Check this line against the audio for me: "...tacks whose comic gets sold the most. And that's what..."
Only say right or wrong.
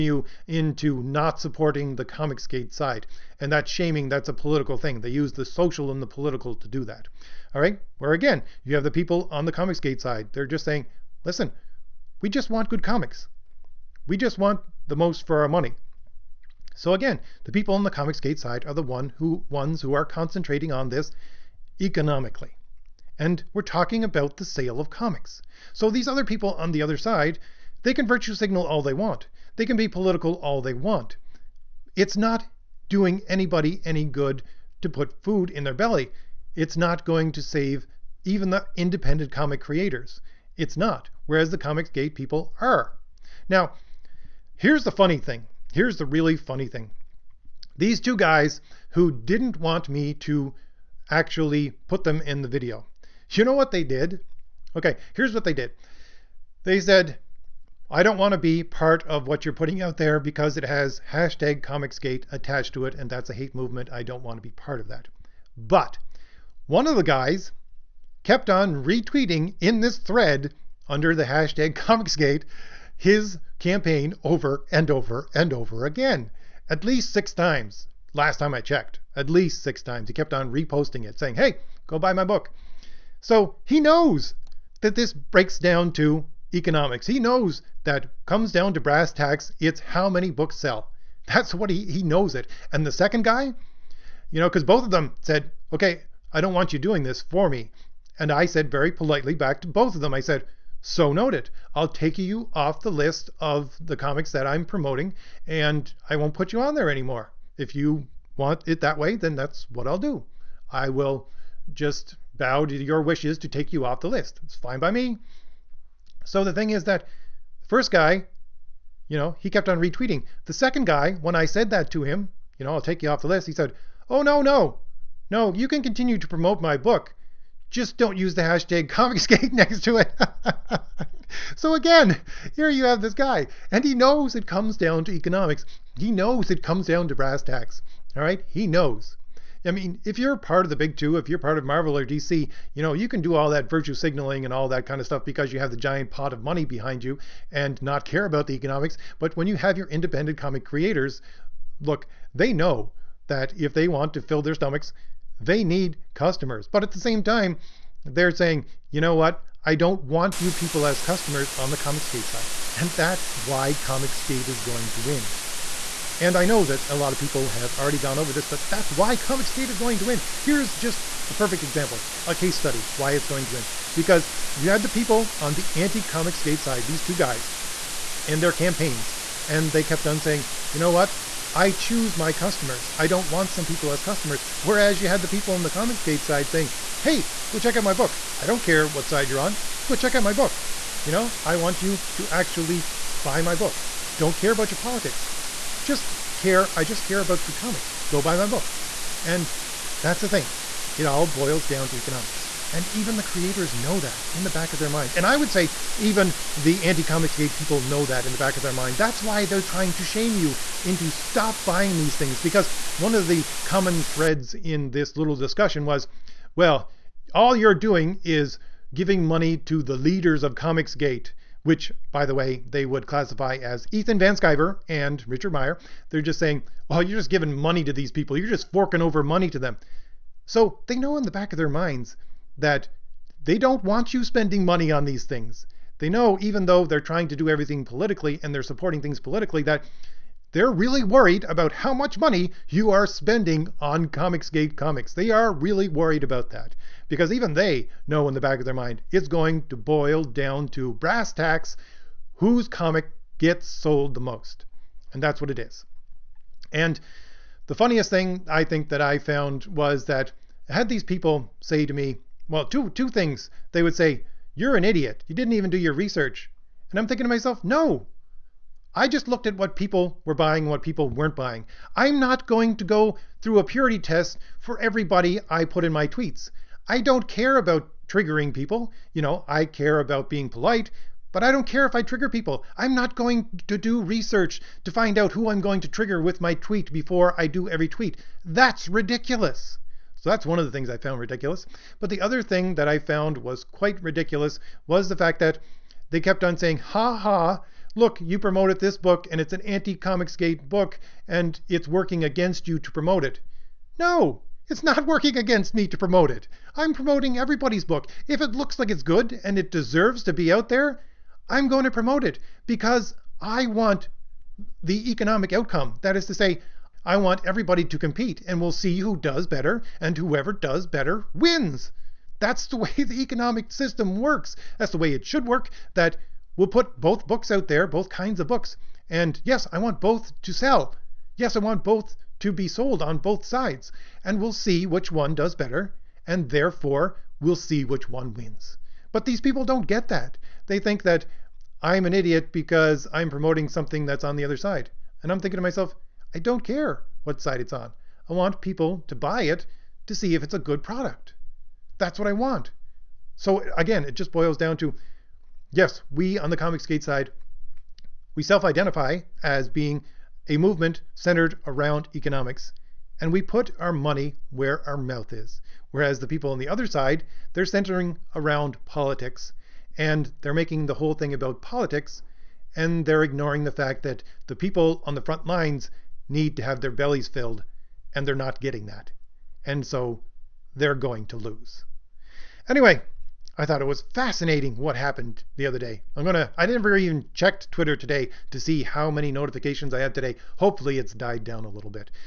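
right.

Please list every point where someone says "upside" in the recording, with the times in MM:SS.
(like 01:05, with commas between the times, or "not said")
not said.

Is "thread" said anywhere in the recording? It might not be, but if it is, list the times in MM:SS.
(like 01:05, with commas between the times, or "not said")
01:09, 03:34.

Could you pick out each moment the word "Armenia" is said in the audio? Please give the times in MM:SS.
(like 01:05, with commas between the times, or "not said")
not said.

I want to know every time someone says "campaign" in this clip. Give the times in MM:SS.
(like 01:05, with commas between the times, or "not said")
01:13, 02:58.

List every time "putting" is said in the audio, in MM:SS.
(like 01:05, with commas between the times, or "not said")
00:59.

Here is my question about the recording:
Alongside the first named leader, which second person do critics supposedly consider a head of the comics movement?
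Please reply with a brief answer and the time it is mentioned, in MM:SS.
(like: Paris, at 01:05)
Richard Meyer, at 03:45.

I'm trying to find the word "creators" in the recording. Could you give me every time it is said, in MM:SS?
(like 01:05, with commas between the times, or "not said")
00:39, 02:30, 03:23.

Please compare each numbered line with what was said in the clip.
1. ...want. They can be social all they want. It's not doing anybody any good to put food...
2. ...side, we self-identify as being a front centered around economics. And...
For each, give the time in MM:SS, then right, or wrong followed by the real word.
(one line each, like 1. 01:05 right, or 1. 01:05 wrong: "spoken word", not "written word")
1. 00:28 wrong: "political", not "social"
2. 05:57 wrong: "movement", not "front".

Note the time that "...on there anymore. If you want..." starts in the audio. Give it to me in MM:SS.
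01:46.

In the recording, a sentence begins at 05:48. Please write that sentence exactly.
I want people to buy it to see if it's a good product.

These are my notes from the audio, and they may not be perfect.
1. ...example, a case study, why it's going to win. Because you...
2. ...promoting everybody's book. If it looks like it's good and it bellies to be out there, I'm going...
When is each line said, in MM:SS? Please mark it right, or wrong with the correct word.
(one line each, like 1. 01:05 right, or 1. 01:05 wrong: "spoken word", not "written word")
1. 02:51 right
2. 05:06 wrong: "deserves", not "bellies".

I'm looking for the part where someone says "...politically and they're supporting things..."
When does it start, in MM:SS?
03:57.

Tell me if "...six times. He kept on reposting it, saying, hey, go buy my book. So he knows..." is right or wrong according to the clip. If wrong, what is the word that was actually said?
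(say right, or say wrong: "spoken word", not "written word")
right.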